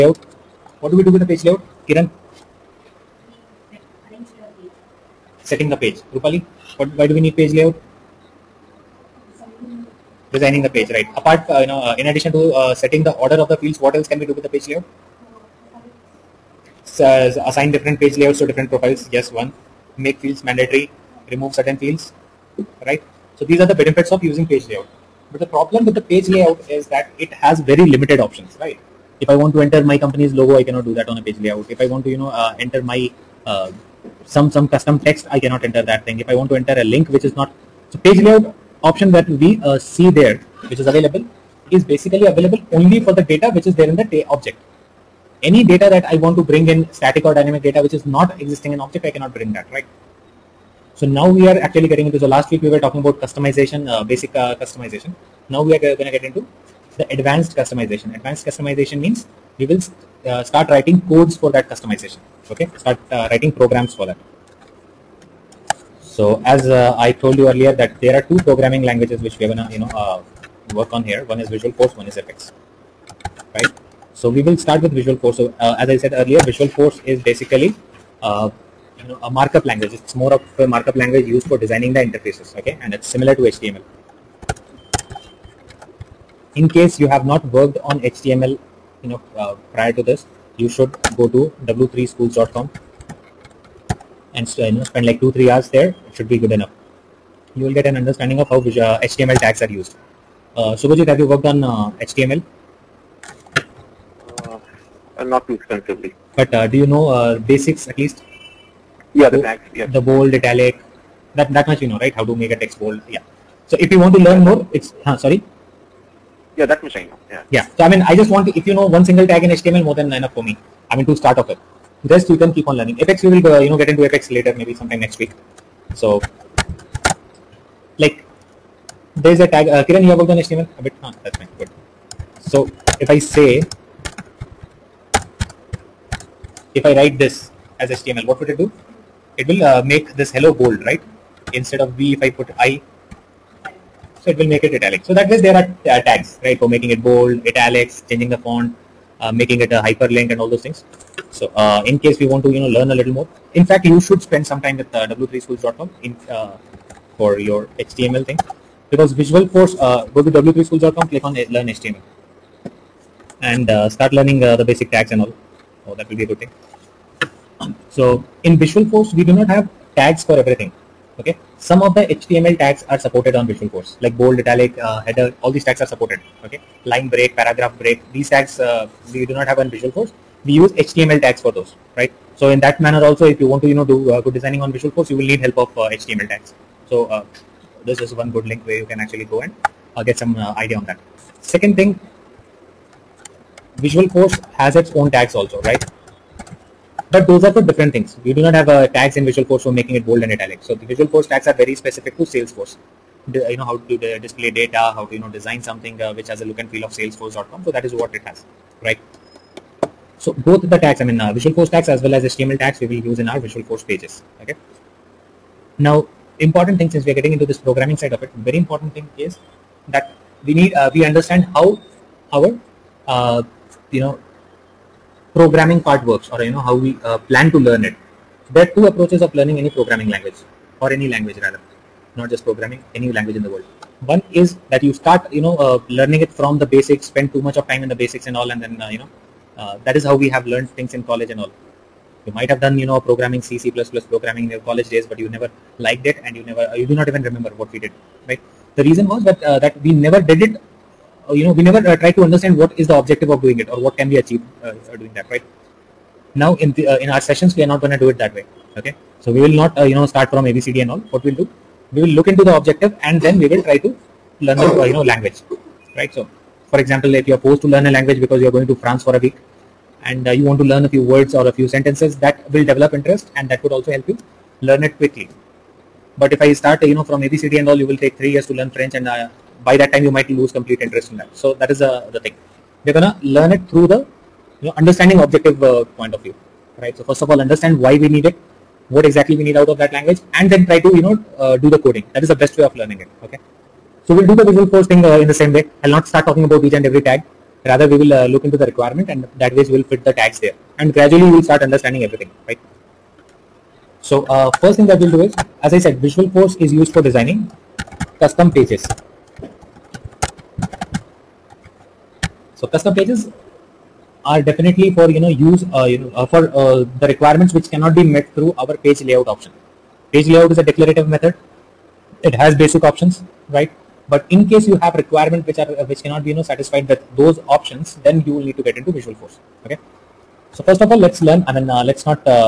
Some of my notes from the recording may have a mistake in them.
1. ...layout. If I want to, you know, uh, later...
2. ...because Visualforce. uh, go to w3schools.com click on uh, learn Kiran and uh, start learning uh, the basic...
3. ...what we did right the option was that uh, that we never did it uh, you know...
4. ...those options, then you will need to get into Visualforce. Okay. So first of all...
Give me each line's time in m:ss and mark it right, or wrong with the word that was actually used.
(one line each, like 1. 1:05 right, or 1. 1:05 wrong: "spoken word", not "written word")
1. 0:31 wrong: "enter", not "later"
2. 2:38 wrong: "HTML", not "Kiran"
3. 4:07 wrong: "reason", not "option"
4. 5:27 right.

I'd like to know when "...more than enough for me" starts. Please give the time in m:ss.
1:59.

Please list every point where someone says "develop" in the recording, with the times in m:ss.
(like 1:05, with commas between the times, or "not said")
4:32.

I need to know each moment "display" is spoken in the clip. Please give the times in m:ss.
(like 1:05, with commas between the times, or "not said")
3:24.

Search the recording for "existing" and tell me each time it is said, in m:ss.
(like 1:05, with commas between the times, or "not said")
0:48.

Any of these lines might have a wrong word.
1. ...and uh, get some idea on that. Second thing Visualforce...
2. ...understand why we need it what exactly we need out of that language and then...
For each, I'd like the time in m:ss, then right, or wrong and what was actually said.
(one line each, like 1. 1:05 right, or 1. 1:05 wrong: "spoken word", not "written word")
1. 3:09 right
2. 4:47 right.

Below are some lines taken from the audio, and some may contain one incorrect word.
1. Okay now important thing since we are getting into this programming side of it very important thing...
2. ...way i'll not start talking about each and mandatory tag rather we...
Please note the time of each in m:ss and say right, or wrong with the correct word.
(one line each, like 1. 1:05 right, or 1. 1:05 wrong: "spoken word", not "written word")
1. 3:34 right
2. 4:55 wrong: "every", not "mandatory".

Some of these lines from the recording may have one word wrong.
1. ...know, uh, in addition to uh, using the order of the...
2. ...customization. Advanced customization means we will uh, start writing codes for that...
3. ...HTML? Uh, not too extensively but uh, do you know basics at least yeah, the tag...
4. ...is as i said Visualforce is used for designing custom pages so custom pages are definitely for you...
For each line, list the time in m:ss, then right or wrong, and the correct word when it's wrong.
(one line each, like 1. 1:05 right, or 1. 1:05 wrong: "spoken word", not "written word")
1. 0:11 wrong: "setting", not "using"
2. 0:57 right
3. 1:42 right
4. 5:05 right.